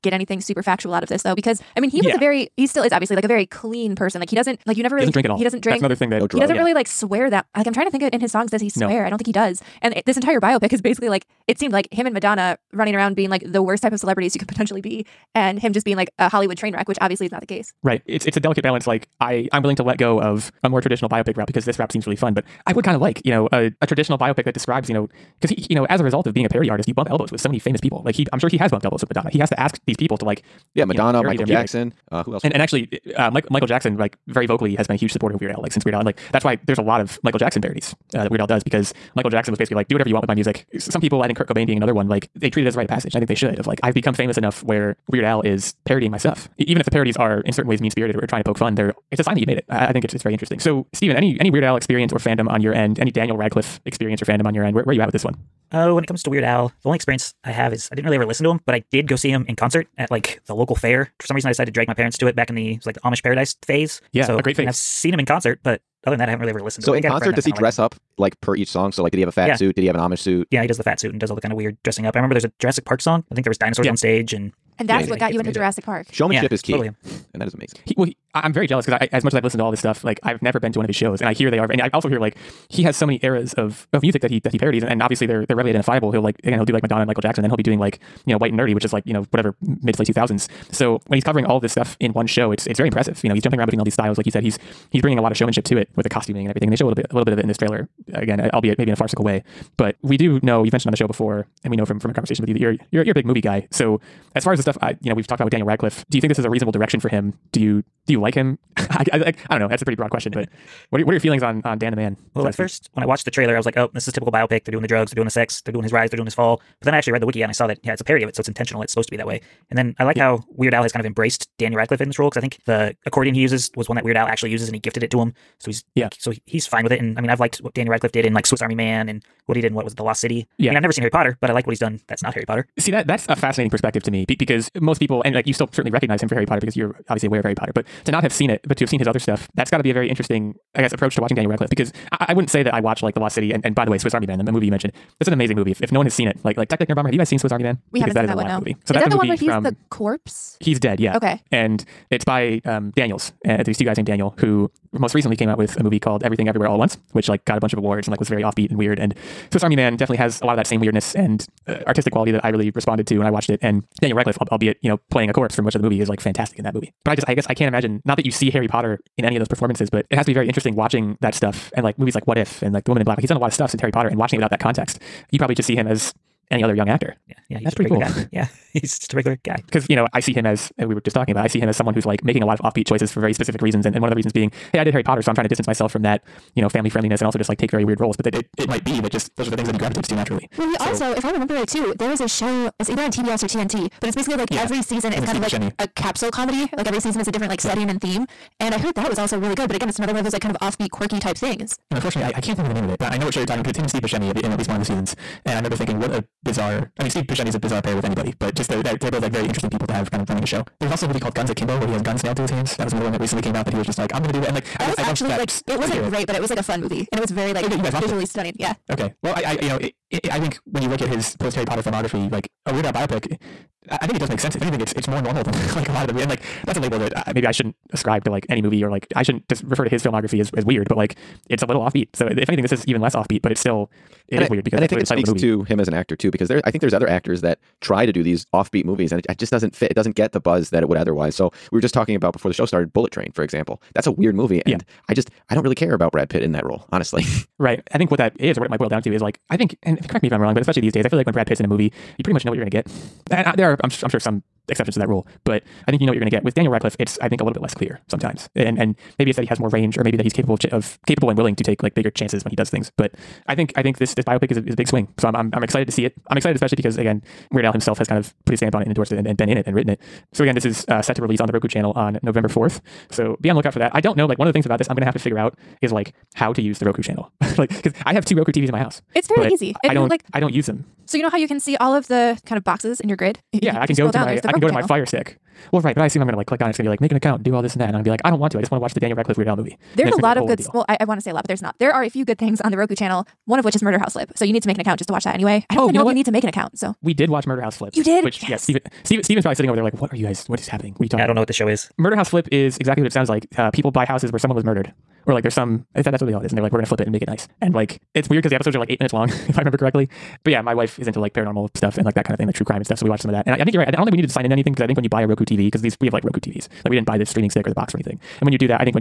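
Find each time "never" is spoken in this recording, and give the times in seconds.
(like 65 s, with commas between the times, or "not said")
4 s, 80 s, 130 s.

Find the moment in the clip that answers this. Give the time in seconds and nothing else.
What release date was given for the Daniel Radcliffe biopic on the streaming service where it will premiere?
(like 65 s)
272 s.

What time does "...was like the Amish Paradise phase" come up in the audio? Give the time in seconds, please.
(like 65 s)
62 s.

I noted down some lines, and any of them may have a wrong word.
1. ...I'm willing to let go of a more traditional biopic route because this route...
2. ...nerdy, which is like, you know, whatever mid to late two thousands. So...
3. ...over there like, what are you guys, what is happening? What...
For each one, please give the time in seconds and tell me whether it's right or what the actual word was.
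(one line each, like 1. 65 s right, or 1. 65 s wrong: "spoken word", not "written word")
1. 19 s right
2. 88 s right
3. 299 s right.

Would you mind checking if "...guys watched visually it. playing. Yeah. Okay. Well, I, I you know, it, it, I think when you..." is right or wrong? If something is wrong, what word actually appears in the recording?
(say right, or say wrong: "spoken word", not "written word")
wrong: "stunning", not "playing".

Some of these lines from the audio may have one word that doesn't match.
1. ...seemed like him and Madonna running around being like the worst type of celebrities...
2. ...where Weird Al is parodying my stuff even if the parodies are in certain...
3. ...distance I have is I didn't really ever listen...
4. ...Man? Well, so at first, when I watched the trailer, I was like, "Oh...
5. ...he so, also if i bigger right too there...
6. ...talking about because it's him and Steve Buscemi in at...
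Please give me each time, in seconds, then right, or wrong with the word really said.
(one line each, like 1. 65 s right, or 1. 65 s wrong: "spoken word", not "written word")
1. 11 s right
2. 44 s right
3. 56 s wrong: "experience", not "distance"
4. 111 s right
5. 190 s wrong: "remember", not "bigger"
6. 203 s right.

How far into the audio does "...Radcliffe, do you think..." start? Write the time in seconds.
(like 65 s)
105 s.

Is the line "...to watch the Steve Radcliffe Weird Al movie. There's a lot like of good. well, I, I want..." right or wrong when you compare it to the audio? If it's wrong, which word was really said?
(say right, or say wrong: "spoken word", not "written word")
wrong: "Daniel", not "Steve".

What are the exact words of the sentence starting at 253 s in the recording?
And I, there are, I'm, I'm sure, some exceptions to that rule, but I think you know what you're going to get.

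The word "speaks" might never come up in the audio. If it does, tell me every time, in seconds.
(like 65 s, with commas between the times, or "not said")
235 s.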